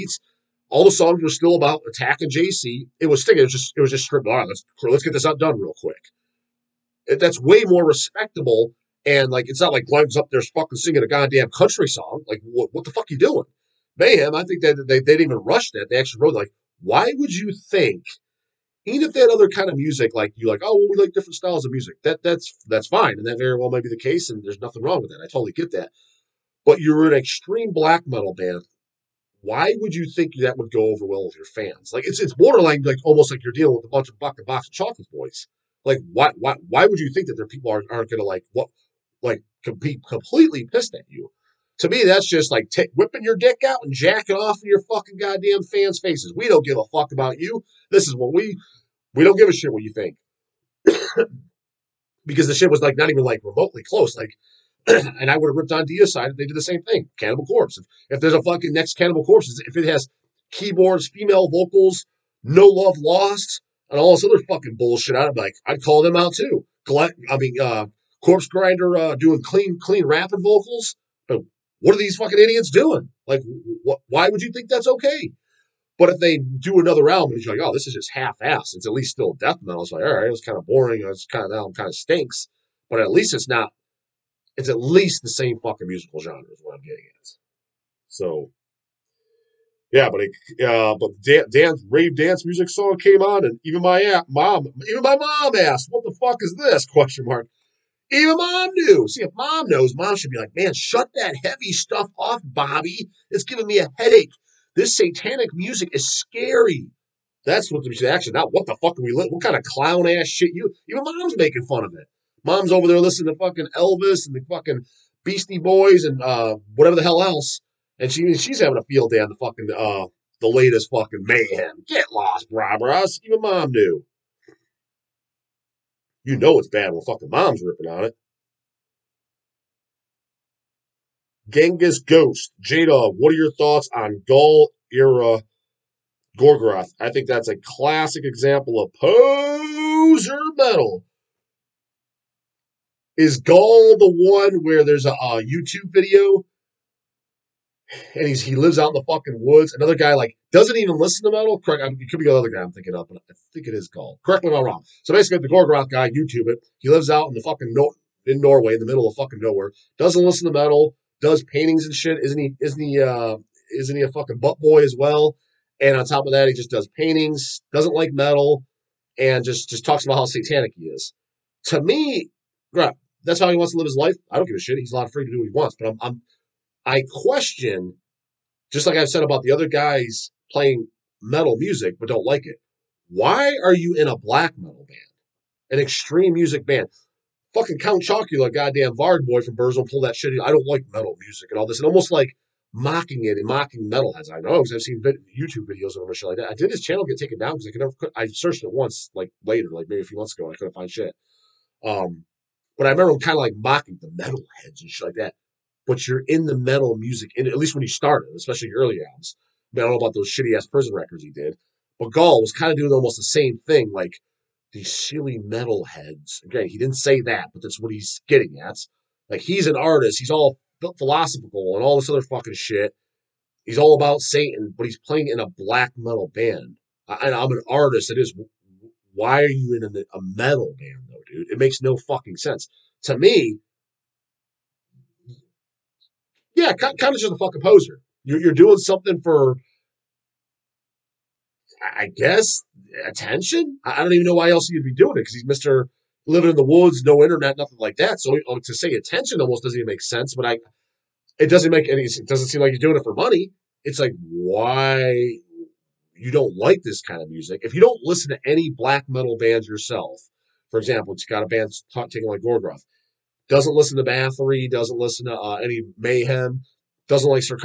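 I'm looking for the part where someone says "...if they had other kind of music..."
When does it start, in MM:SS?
00:19.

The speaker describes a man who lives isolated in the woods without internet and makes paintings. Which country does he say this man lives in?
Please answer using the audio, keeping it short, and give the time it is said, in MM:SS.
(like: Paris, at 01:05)
Norway, at 02:38.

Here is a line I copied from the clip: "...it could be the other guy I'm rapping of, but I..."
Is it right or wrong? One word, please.
wrong.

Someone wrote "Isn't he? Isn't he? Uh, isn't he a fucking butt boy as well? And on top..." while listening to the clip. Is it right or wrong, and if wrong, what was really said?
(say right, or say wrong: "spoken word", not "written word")
right.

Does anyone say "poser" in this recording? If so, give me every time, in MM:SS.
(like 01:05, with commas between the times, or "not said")
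02:18, 03:57.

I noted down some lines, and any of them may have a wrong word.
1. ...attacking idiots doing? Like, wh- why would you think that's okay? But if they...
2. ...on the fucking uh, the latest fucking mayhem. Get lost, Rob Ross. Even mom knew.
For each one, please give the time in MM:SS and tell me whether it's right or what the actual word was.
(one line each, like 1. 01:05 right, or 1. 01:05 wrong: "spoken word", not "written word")
1. 01:12 wrong: "fucking", not "attacking"
2. 01:59 right.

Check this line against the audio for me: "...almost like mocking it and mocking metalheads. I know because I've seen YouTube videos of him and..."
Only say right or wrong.
right.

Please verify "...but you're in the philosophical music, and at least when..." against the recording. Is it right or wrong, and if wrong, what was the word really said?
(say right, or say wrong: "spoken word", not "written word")
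wrong: "metal", not "philosophical".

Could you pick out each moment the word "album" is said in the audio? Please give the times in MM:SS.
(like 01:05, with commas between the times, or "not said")
01:21, 03:29.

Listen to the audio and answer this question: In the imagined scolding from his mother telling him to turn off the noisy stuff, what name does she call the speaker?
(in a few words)
Bobby.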